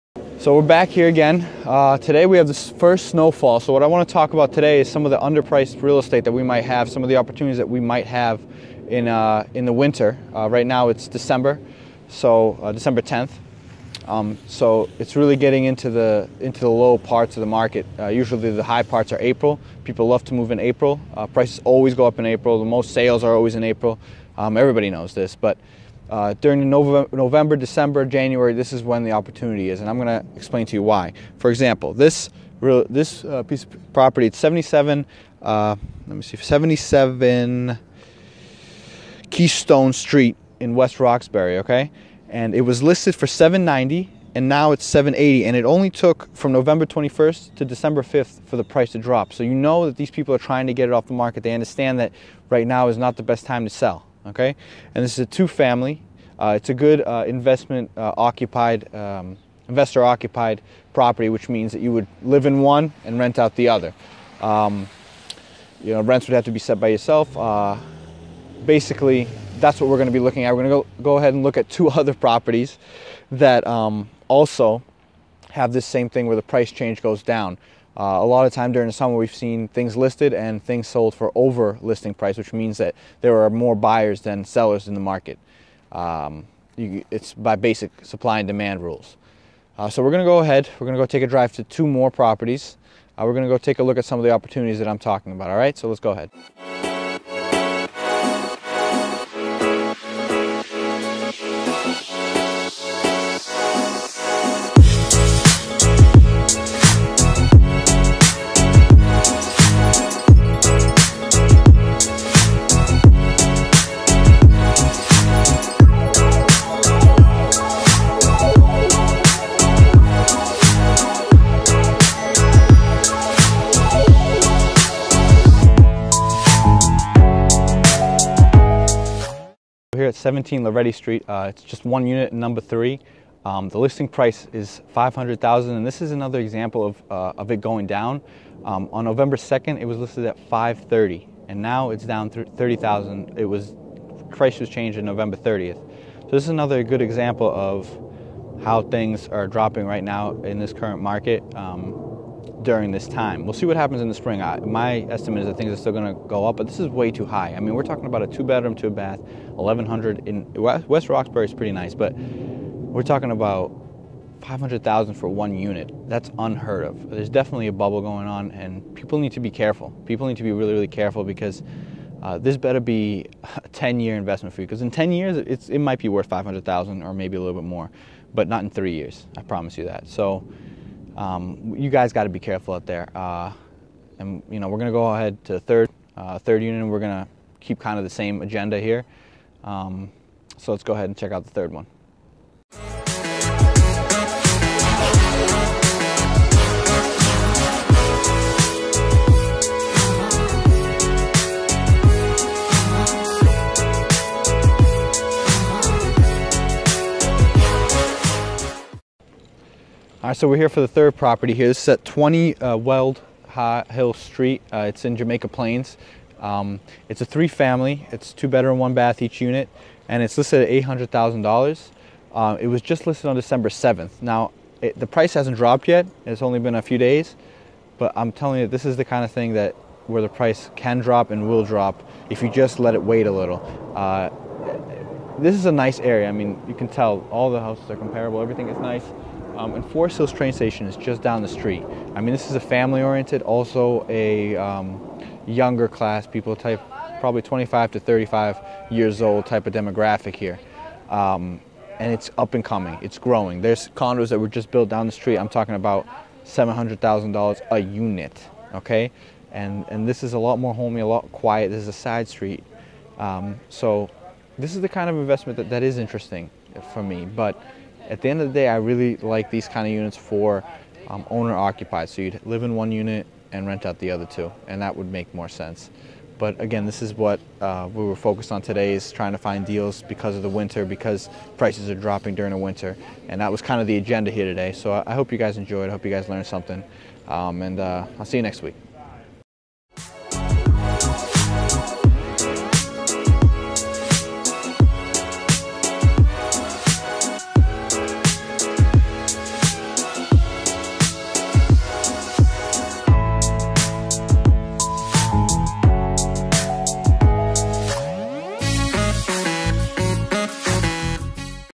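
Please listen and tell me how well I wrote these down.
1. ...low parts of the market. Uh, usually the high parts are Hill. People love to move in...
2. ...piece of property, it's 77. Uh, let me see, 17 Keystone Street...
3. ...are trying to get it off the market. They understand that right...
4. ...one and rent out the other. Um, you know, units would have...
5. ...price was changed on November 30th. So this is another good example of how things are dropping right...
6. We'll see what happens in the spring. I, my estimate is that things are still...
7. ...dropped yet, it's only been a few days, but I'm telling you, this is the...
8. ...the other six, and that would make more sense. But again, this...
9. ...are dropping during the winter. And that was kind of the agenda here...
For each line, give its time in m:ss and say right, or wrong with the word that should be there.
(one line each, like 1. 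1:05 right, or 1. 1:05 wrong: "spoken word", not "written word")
1. 0:16 wrong: "April", not "Hill"
2. 0:33 wrong: "77", not "17"
3. 0:50 right
4. 1:02 wrong: "rents", not "units"
5. 2:24 right
6. 2:33 right
7. 3:45 right
8. 4:33 wrong: "two", not "six"
9. 4:41 right.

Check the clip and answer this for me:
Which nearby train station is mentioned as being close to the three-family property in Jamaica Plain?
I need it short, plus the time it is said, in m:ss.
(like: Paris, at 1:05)
Forest Hills, at 3:59.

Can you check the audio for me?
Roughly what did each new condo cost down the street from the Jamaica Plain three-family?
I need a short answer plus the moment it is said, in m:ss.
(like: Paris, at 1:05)
$700,000, at 4:16.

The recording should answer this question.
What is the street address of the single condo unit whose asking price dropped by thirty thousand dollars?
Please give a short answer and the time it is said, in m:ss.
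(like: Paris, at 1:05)
17 Loretti Street, at 2:10.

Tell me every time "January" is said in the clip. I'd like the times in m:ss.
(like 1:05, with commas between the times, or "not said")
0:28.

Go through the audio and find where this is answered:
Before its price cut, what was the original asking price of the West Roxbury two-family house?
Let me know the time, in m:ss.
0:43.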